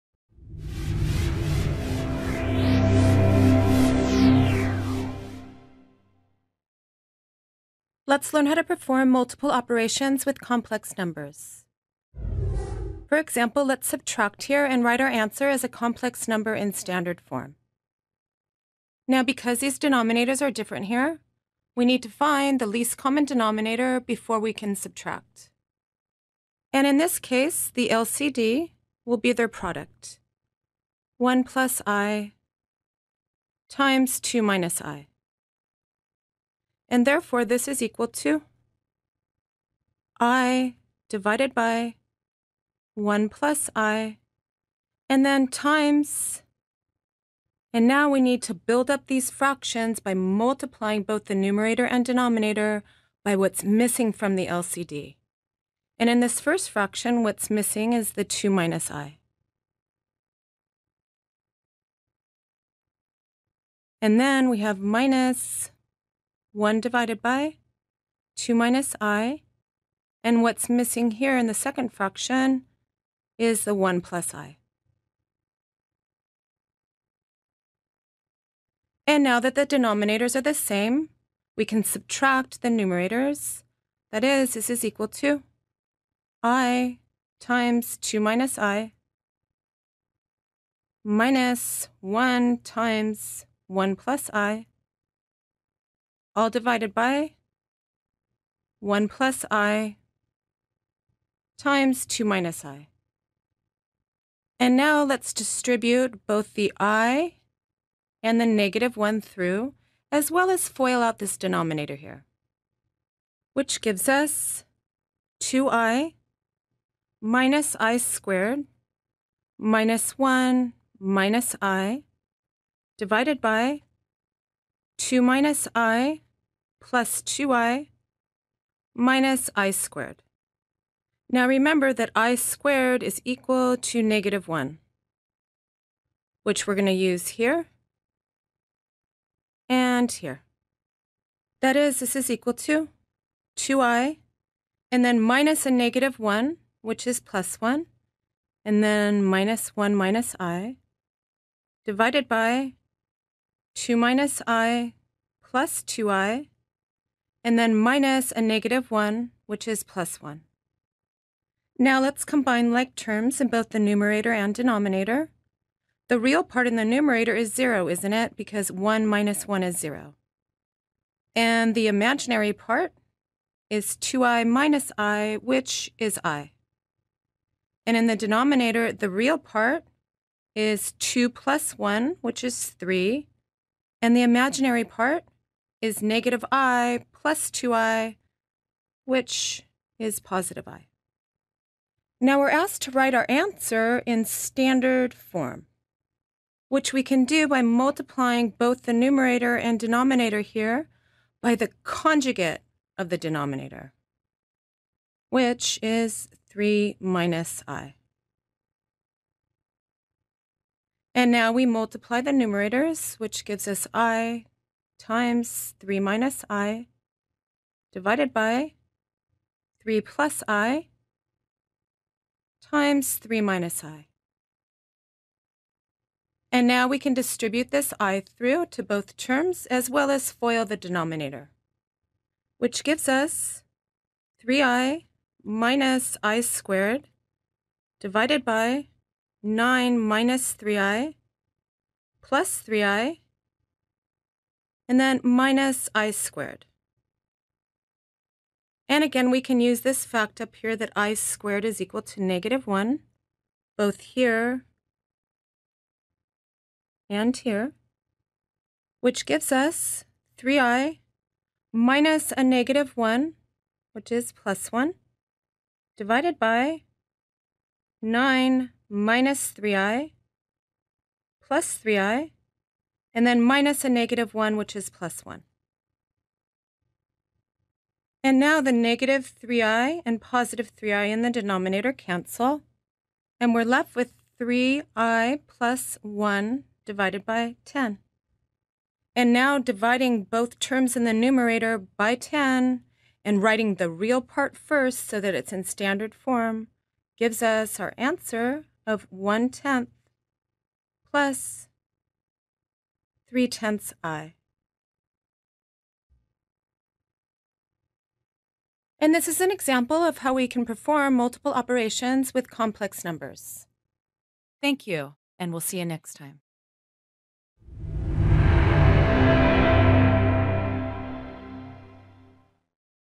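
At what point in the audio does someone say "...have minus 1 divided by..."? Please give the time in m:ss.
1:04.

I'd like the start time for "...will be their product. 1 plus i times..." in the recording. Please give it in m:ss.
0:29.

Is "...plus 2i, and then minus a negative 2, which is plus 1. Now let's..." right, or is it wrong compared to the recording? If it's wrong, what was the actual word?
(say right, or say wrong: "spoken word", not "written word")
wrong: "1", not "2".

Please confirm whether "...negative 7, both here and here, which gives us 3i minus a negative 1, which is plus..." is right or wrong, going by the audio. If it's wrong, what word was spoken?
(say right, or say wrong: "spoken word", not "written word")
wrong: "1", not "7".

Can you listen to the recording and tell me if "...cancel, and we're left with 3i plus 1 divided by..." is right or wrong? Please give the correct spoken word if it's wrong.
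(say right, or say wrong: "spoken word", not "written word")
right.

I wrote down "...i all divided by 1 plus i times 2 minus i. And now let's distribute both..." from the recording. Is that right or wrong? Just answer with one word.
right.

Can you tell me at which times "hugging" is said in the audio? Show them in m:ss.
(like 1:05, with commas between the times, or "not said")
not said.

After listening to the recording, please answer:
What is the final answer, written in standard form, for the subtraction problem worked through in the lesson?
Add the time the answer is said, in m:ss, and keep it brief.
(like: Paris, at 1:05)
1/10 + 3/10 i, at 4:59.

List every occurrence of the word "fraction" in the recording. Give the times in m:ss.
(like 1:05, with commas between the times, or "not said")
0:49, 0:56, 1:11.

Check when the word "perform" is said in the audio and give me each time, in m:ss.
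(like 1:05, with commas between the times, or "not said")
0:08, 5:10.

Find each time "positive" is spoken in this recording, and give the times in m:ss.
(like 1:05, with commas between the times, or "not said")
3:10, 4:40.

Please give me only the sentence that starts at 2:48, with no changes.
Because 1 minus 1 is 0.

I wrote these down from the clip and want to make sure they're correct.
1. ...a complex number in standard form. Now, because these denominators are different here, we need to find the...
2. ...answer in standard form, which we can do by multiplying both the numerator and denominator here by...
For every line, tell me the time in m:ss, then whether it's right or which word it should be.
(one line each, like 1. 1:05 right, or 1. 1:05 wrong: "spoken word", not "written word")
1. 0:15 right
2. 3:13 right.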